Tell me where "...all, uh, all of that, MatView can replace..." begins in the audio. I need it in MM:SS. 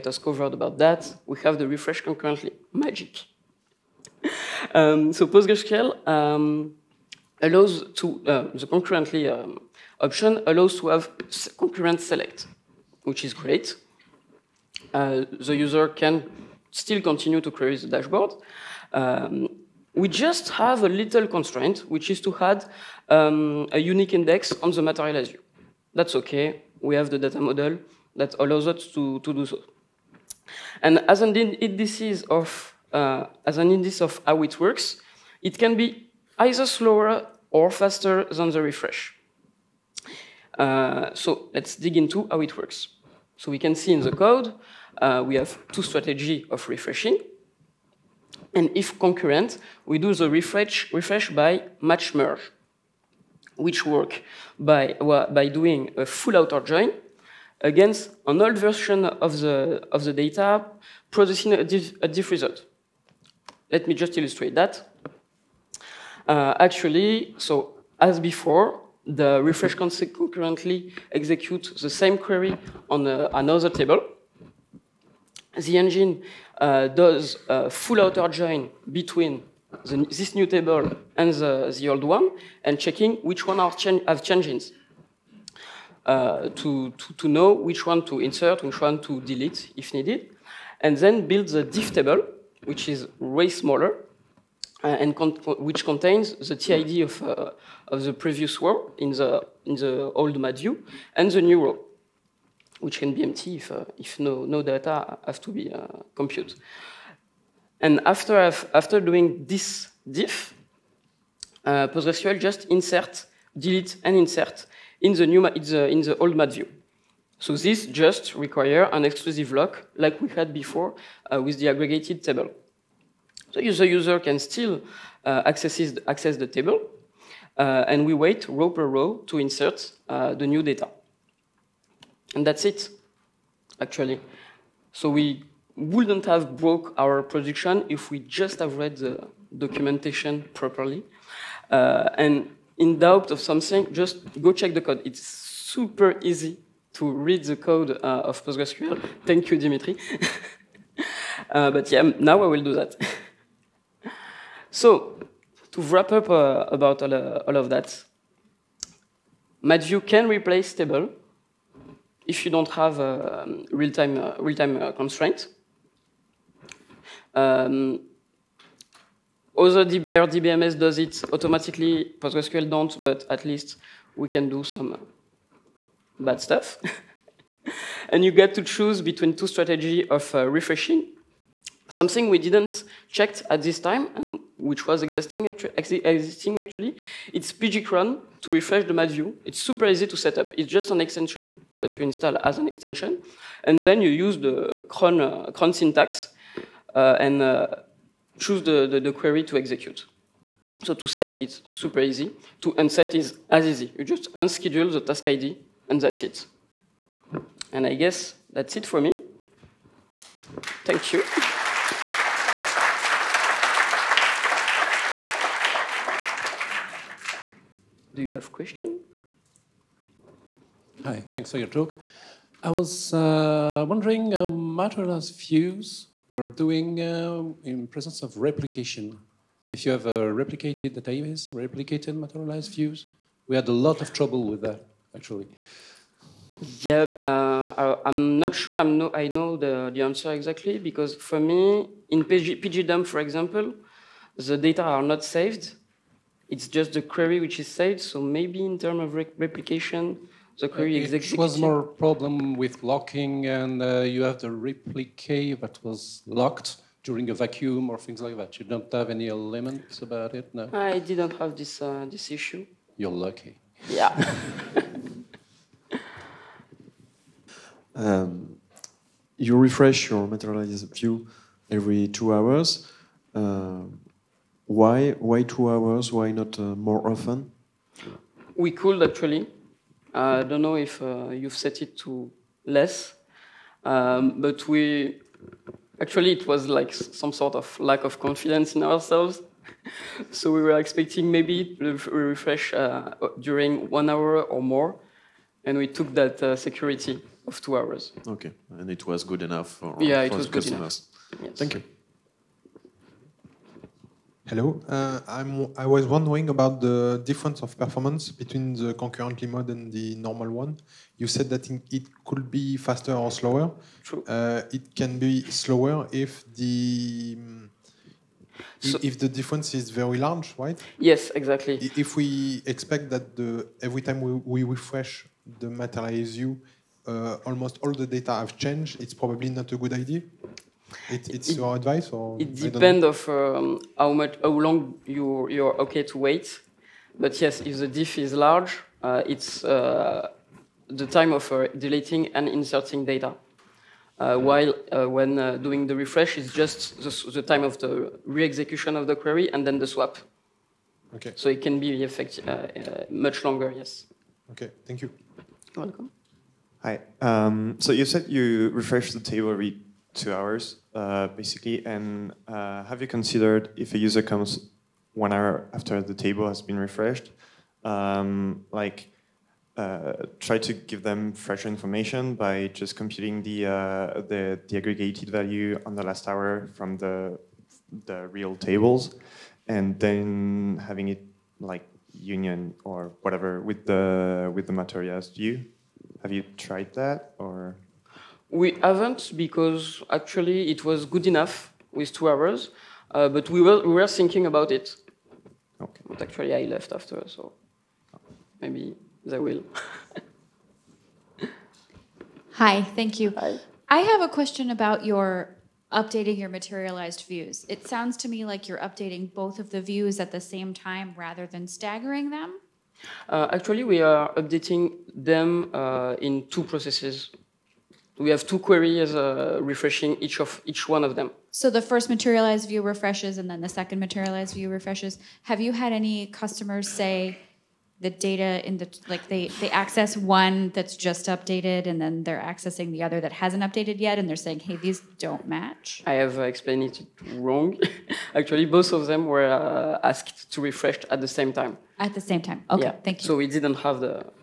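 02:37.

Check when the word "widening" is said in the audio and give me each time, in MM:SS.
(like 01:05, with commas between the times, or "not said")
not said.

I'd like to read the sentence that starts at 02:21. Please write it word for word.
Uh, and in doubt of something, just go check the code.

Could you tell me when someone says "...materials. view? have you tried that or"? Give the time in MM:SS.
06:24.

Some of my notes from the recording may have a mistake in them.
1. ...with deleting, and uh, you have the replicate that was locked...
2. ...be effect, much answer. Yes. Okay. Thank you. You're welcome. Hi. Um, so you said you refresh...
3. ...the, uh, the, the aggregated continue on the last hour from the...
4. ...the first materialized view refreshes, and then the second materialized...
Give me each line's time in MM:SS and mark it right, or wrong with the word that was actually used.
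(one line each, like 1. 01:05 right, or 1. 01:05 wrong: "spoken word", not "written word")
1. 04:12 wrong: "locking", not "deleting"
2. 05:51 wrong: "longer", not "answer"
3. 06:13 wrong: "value", not "continue"
4. 07:01 right.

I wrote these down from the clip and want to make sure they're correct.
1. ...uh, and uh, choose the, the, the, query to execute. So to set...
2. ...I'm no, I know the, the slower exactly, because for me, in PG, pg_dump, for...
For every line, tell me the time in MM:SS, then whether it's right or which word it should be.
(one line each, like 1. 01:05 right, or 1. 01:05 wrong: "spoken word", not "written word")
1. 03:16 right
2. 03:58 wrong: "answer", not "slower".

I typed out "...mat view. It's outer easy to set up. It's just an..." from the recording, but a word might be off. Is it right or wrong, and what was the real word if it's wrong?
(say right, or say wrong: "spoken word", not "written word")
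wrong: "super", not "outer".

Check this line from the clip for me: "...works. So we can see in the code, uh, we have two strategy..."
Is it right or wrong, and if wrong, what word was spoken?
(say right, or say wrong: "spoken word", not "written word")
right.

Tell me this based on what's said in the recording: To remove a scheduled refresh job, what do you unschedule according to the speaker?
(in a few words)
The task ID.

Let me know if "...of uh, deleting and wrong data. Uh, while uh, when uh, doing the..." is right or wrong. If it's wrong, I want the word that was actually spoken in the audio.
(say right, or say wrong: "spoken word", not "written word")
wrong: "inserting", not "wrong".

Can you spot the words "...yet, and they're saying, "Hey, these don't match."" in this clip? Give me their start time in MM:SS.
07:14.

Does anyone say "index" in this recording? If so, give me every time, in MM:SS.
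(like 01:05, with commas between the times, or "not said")
00:24, 00:33.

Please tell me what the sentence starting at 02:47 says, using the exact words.
Um, other DB RDBMS does it automatically.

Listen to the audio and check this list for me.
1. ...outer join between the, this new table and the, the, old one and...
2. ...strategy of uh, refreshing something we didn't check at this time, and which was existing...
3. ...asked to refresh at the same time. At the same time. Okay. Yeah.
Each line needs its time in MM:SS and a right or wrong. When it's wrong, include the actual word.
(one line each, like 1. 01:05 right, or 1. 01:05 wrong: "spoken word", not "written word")
1. 01:18 right
2. 02:59 right
3. 07:20 right.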